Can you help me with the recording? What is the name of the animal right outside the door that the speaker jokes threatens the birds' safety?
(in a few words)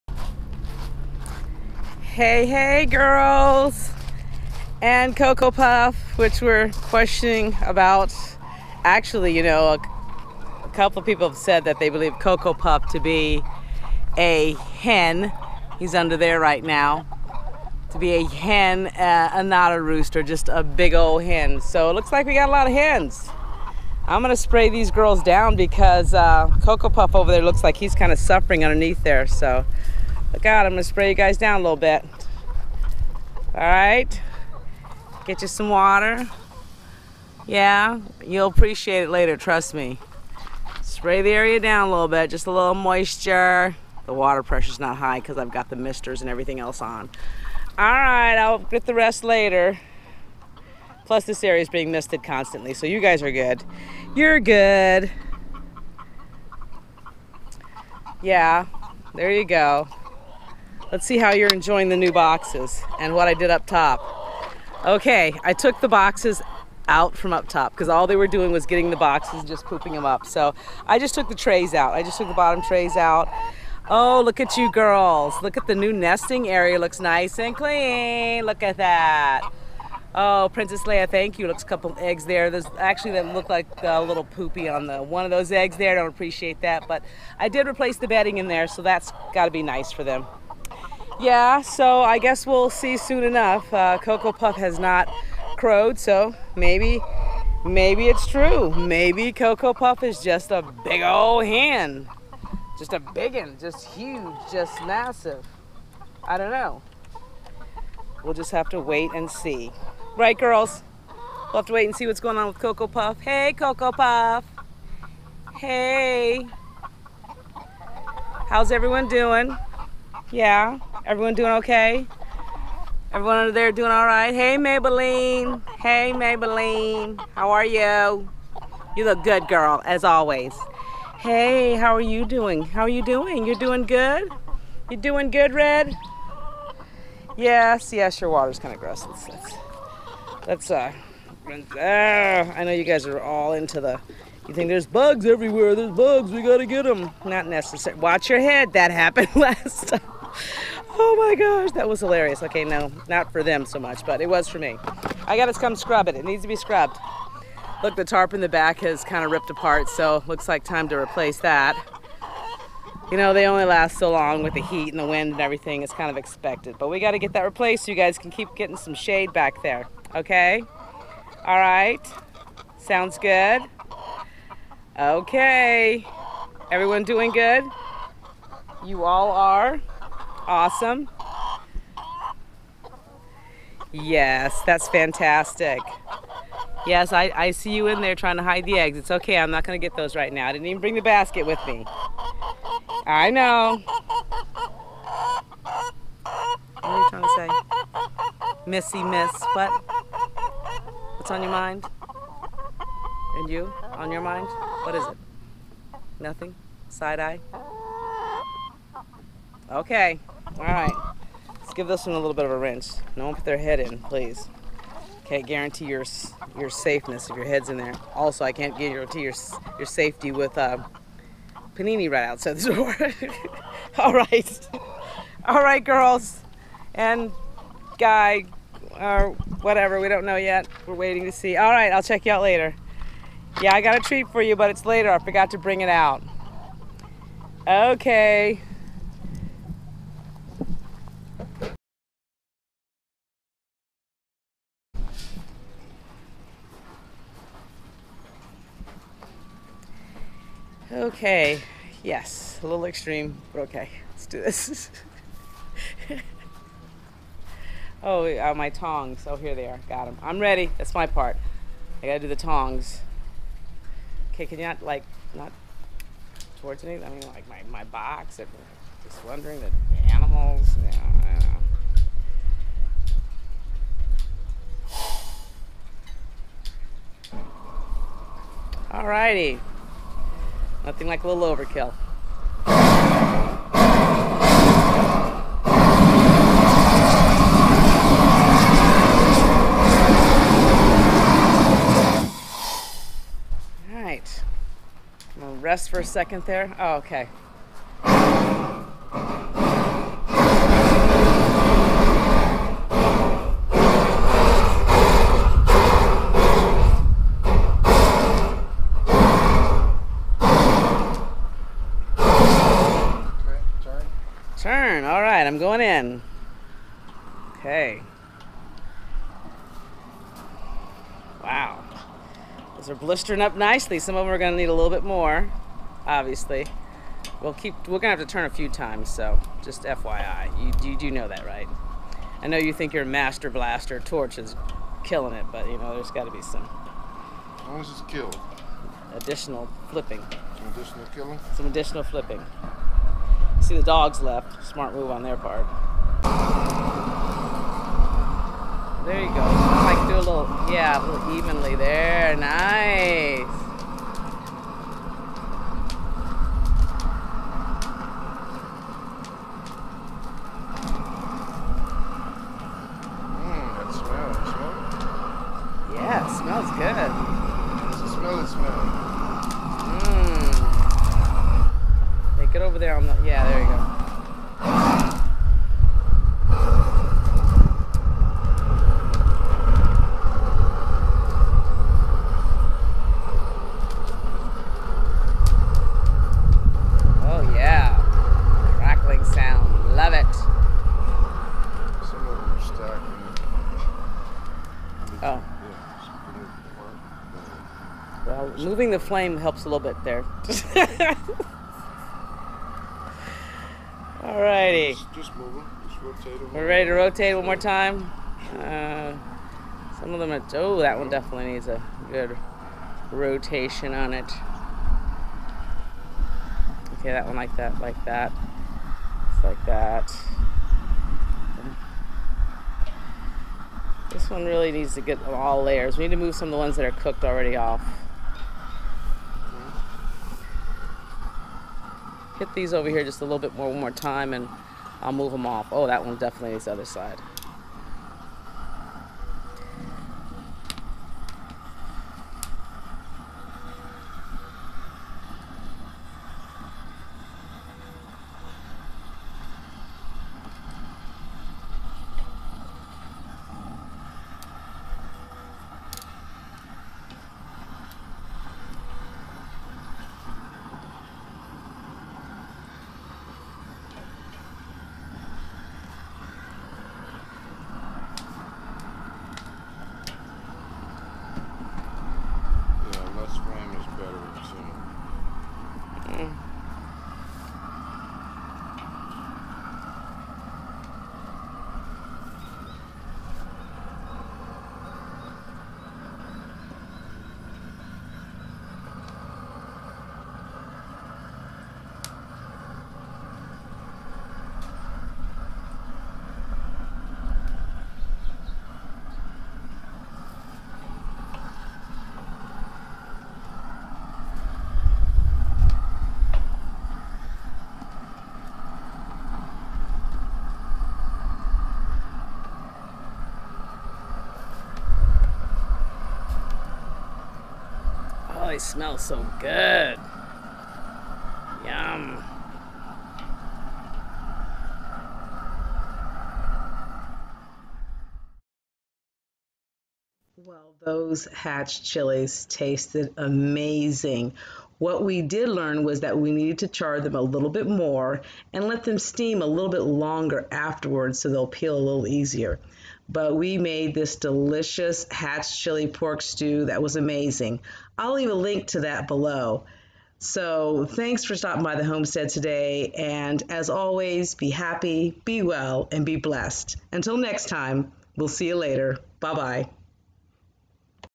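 Panini.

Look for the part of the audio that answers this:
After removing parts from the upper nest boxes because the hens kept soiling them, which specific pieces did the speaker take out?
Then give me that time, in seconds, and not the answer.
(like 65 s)
72 s.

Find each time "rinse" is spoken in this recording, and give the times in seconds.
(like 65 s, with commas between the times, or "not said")
212 s.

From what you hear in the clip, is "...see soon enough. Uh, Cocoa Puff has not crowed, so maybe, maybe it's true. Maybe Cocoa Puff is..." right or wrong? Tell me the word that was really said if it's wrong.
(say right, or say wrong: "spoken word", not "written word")
right.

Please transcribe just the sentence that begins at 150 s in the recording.
Oh my gosh, that was hilarious.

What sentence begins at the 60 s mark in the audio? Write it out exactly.
Let's see how you're enjoying the new boxes and what I did up top.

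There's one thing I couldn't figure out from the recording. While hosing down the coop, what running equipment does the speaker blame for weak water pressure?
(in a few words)
misters.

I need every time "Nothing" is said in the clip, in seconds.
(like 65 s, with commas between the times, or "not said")
206 s, 280 s.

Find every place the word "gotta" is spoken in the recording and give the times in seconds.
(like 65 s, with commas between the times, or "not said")
146 s, 155 s, 262 s, 336 s.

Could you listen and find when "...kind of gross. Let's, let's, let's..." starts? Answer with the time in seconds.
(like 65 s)
138 s.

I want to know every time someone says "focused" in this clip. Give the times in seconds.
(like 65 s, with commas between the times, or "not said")
not said.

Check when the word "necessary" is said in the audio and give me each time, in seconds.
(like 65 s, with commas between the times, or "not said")
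147 s.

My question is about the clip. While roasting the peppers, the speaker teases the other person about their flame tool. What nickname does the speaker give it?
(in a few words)
master blaster torch.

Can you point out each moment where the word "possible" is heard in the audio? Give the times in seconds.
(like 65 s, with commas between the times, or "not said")
not said.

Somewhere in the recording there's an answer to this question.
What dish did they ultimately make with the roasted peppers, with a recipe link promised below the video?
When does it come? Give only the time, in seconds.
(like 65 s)
545 s.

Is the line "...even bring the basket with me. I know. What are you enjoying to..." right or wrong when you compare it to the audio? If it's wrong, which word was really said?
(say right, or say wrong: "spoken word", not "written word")
wrong: "trying", not "enjoying".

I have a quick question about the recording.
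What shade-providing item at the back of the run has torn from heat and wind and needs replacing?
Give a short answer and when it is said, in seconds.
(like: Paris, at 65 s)
tarp, at 158 s.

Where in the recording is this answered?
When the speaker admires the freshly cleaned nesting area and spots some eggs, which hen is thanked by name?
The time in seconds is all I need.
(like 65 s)
80 s.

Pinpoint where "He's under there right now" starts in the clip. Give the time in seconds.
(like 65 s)
15 s.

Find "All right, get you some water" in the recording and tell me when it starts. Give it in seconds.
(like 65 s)
33 s.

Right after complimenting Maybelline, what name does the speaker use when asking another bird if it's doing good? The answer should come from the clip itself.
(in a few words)
Red.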